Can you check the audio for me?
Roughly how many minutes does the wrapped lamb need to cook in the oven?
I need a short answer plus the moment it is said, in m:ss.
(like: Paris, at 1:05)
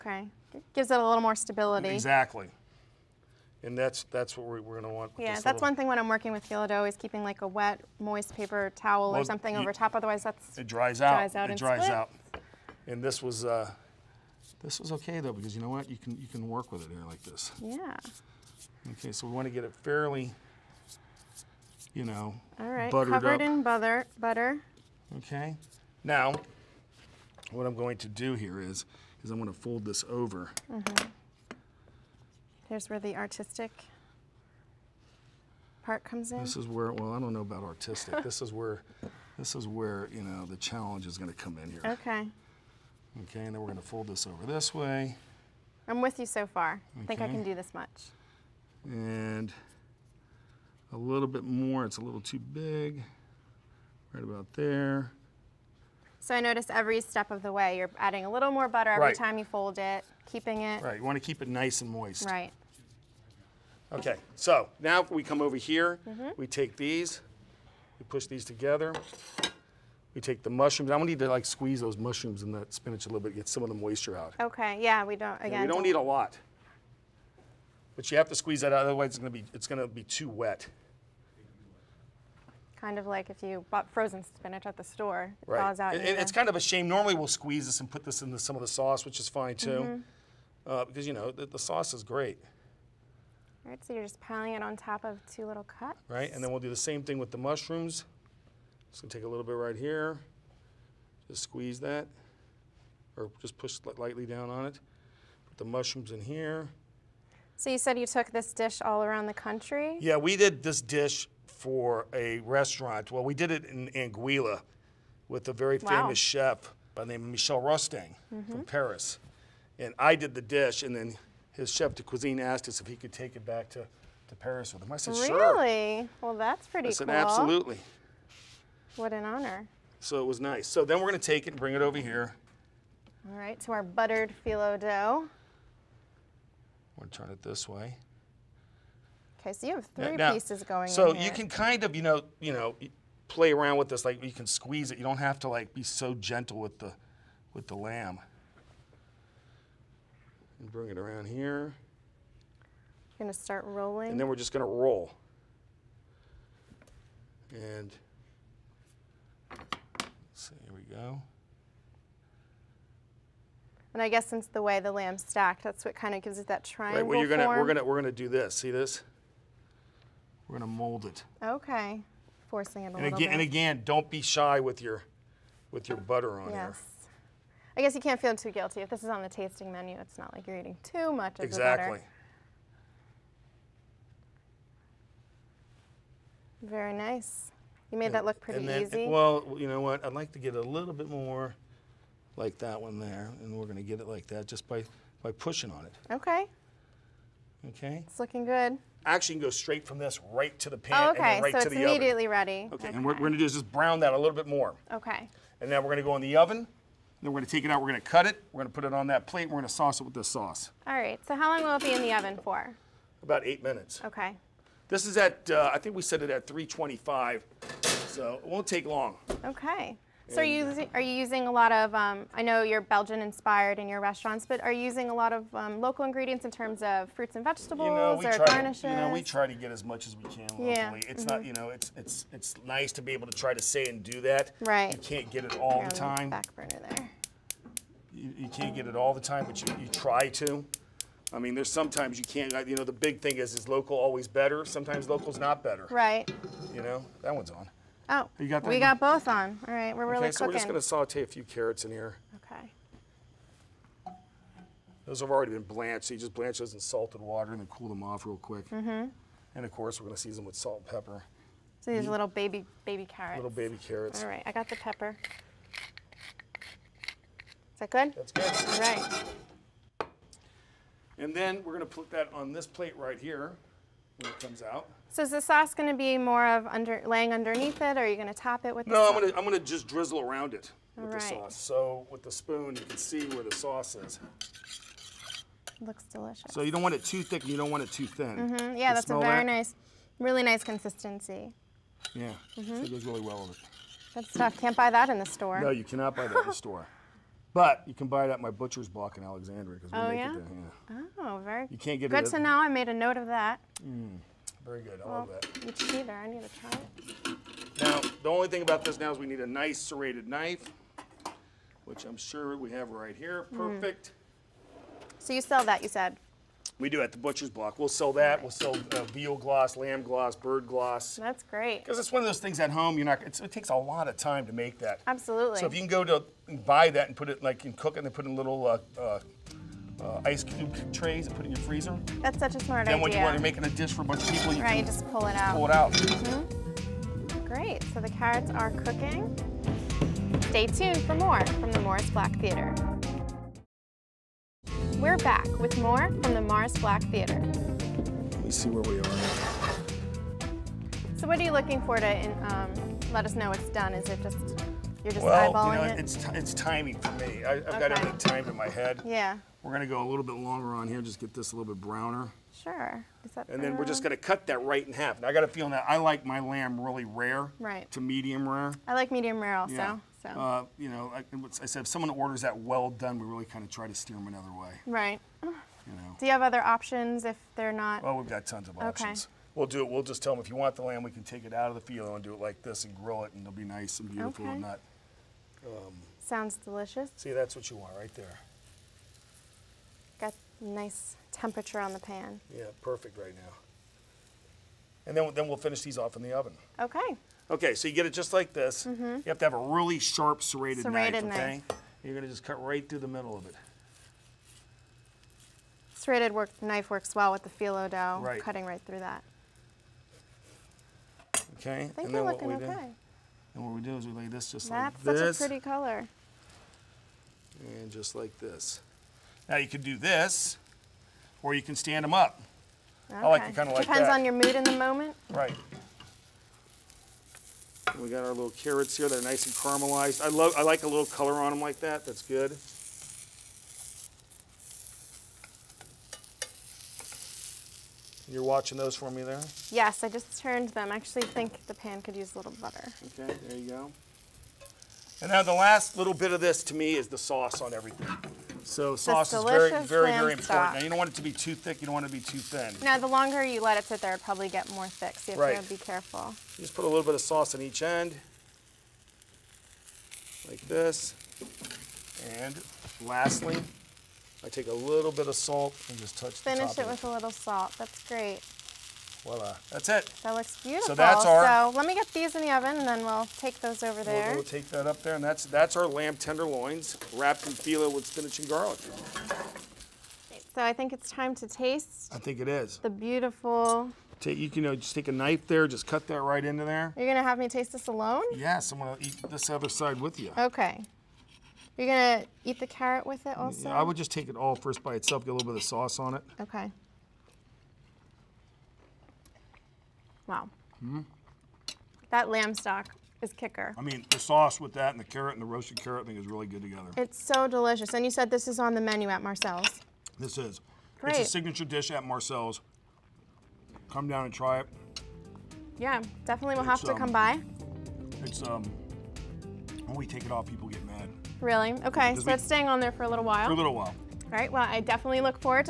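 8, at 3:33.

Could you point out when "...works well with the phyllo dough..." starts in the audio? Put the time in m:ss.
6:46.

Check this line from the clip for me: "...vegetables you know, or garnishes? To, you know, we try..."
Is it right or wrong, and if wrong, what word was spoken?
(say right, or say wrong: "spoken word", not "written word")
right.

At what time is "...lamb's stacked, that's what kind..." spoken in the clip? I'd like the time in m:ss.
2:44.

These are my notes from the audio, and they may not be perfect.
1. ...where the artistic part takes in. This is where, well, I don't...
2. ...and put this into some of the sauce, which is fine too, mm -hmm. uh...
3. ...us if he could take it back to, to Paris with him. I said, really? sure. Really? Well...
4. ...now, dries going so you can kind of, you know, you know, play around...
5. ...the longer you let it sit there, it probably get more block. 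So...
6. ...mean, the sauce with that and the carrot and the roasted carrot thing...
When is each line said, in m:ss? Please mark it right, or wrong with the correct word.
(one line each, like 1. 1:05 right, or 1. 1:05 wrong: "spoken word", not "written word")
1. 0:32 wrong: "comes", not "takes"
2. 1:27 right
3. 2:02 right
4. 2:20 wrong: "pieces", not "dries"
5. 7:32 wrong: "thick", not "block"
6. 8:23 right.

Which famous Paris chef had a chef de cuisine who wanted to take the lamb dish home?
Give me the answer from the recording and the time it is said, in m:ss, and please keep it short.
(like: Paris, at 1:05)
Michel Rostang, at 1:57.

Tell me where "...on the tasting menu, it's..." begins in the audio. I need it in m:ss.
2:59.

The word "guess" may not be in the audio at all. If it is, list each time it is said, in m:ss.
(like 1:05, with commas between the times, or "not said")
2:44, 2:57.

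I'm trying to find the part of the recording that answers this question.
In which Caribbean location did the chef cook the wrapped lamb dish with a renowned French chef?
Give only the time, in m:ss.
1:53.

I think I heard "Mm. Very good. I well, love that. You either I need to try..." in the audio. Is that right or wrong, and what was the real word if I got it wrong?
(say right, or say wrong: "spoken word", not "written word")
right.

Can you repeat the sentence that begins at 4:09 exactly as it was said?
All right, we're really okay, so cooking.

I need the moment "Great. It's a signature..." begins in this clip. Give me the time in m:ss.
8:30.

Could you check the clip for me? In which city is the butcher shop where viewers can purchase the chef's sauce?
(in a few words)
Alexandria.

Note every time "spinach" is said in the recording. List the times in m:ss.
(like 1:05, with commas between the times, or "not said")
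1:12, 1:24, 7:58.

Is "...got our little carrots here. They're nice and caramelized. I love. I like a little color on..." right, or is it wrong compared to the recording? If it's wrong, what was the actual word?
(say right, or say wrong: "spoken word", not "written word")
right.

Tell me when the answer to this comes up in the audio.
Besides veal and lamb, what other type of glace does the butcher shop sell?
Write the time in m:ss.
5:20.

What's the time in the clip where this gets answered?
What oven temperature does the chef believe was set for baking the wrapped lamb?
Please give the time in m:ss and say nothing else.
3:36.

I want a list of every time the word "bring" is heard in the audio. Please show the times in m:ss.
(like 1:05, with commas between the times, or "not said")
2:11, 2:30.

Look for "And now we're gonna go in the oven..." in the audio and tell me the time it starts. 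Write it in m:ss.
3:25.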